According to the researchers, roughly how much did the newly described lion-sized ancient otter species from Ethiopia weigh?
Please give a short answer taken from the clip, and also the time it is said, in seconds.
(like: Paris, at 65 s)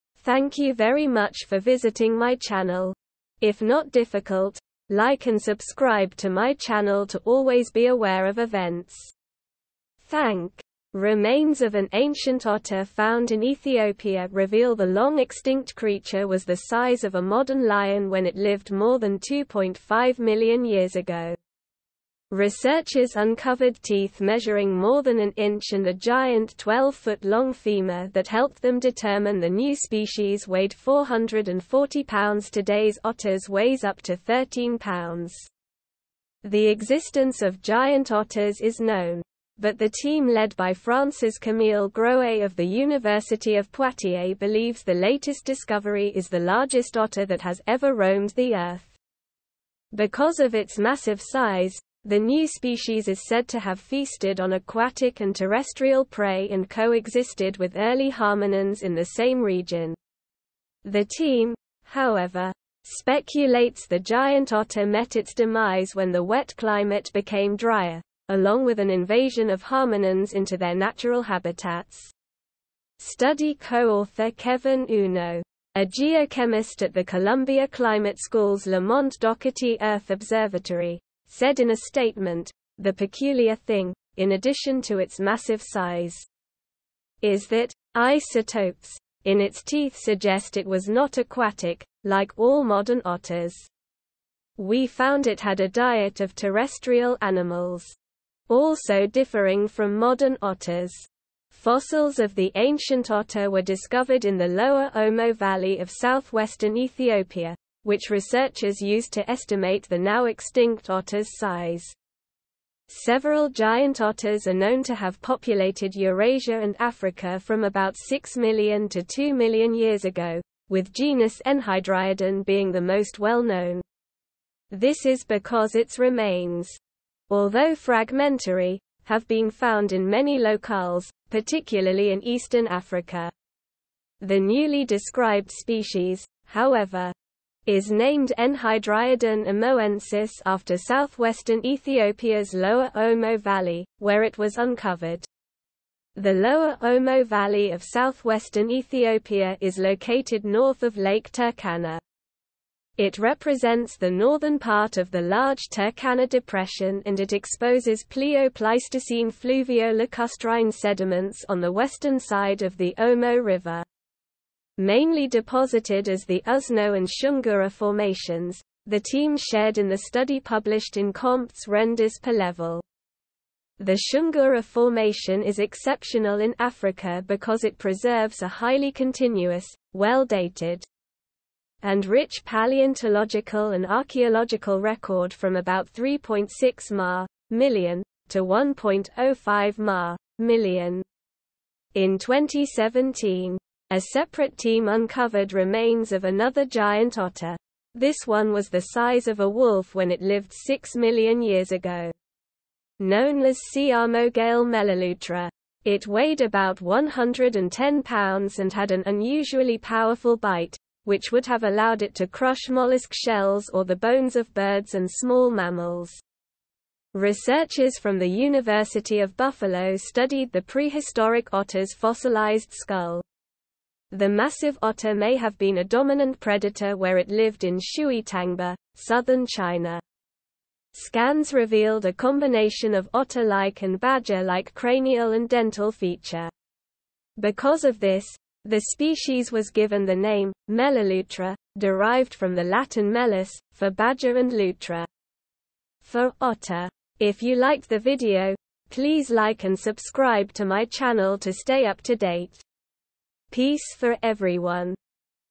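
440 pounds, at 30 s.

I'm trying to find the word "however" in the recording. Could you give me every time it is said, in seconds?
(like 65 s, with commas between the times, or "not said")
61 s, 136 s.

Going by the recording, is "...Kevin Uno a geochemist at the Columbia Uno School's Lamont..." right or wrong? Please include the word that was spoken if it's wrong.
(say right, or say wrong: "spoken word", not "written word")
wrong: "Climate", not "Uno".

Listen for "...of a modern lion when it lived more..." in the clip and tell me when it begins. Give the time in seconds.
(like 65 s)
17 s.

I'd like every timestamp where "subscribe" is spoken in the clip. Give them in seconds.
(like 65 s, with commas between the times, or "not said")
5 s, 249 s.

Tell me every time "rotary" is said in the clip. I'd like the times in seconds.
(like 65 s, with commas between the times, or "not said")
not said.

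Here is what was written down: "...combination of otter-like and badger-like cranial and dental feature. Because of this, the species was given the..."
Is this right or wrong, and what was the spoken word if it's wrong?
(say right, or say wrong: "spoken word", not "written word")
right.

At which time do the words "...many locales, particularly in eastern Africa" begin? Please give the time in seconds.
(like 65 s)
130 s.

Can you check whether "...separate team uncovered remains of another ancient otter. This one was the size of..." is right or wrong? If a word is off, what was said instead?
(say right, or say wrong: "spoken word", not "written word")
wrong: "giant", not "ancient".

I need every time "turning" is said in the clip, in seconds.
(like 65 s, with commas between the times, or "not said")
not said.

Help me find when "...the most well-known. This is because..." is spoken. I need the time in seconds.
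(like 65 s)
122 s.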